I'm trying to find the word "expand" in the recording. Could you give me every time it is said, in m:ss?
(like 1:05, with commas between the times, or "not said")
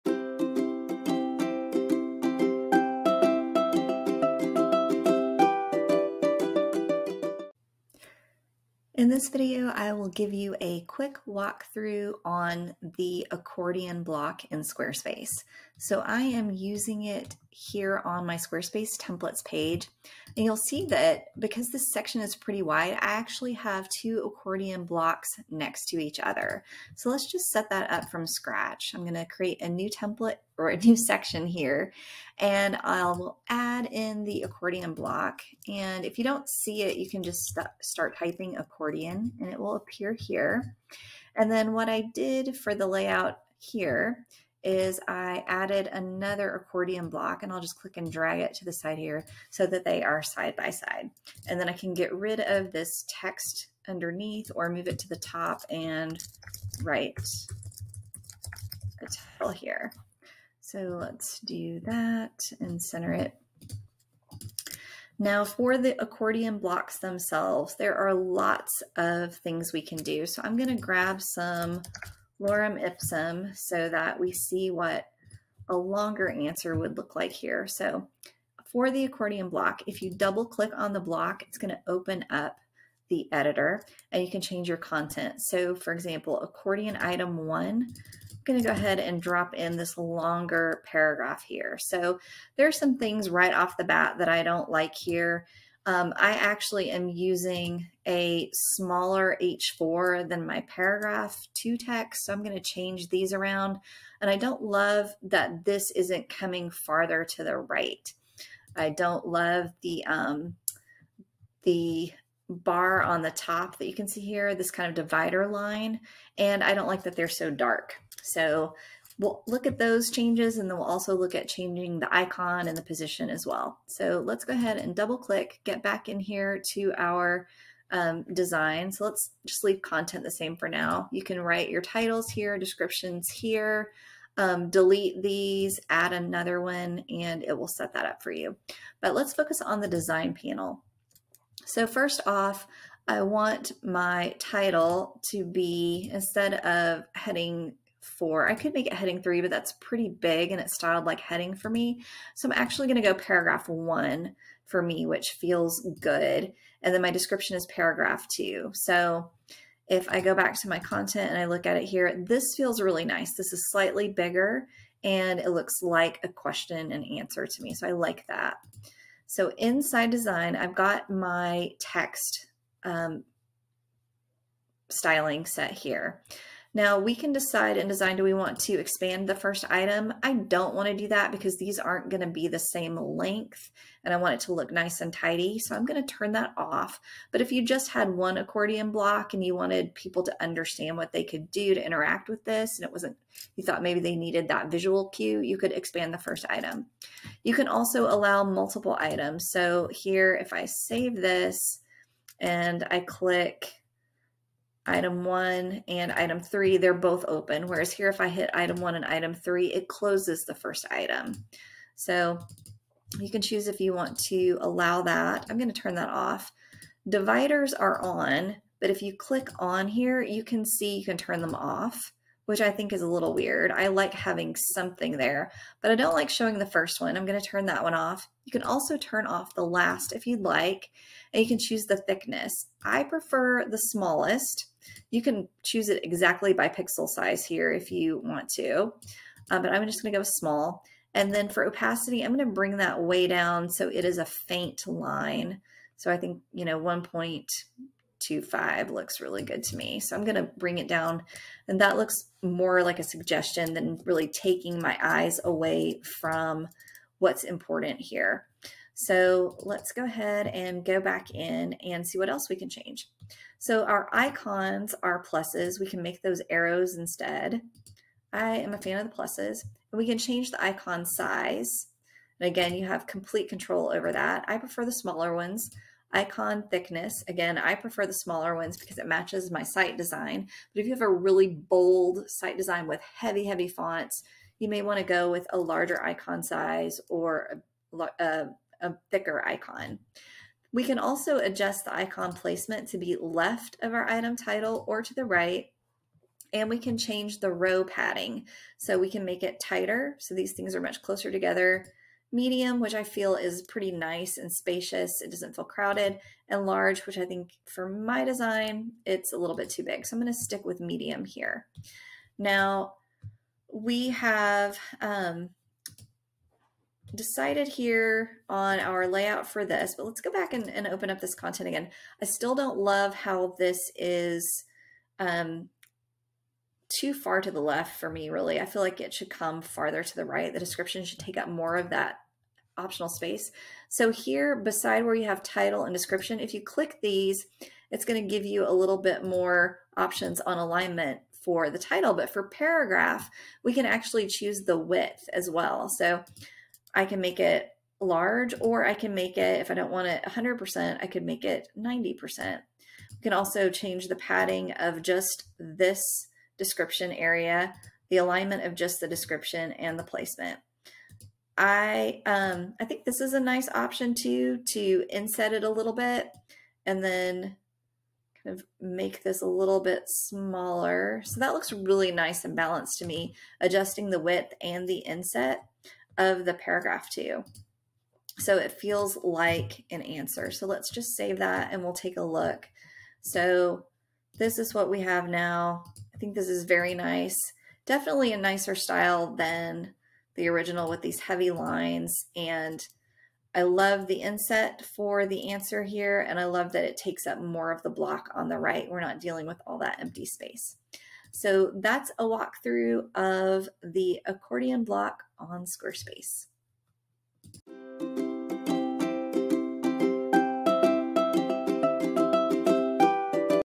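2:58, 3:15.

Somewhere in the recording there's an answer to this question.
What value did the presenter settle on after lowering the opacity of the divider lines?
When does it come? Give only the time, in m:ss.
4:06.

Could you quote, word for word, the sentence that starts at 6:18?
So it feels like an answer.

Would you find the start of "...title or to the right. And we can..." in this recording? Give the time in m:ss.
4:54.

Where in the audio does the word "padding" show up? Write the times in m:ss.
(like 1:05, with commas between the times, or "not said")
4:57, 5:54.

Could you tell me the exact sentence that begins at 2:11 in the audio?
You can write your titles here, descriptions here, um, delete these, add another one, and it will set that up for you.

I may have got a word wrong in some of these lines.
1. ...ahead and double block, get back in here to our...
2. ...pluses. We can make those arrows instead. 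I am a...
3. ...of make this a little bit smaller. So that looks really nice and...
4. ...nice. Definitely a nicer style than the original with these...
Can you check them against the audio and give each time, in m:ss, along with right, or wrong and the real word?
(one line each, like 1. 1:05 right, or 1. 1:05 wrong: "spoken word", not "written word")
1. 2:04 wrong: "click", not "block"
2. 4:25 right
3. 6:08 right
4. 6:26 right.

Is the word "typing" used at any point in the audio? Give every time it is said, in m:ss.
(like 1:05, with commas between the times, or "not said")
0:38.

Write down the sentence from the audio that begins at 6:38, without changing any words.
We're not dealing with all that empty space.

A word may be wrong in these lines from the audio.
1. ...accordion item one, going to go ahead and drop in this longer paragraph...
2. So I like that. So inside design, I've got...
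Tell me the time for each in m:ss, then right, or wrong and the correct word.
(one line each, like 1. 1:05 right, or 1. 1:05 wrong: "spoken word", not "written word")
1. 1:26 right
2. 2:47 right.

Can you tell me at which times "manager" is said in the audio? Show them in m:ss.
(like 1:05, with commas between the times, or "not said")
not said.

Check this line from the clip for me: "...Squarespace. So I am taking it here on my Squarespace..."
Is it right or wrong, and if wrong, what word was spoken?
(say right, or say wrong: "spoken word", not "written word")
wrong: "using", not "taking".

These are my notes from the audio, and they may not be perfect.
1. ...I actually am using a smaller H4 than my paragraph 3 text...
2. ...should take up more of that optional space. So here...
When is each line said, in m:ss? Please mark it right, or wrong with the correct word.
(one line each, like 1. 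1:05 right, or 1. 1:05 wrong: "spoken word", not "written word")
1. 1:36 wrong: "2", not "3"
2. 5:31 right.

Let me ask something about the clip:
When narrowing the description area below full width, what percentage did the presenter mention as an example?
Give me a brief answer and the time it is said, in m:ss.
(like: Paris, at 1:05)
90%, at 5:51.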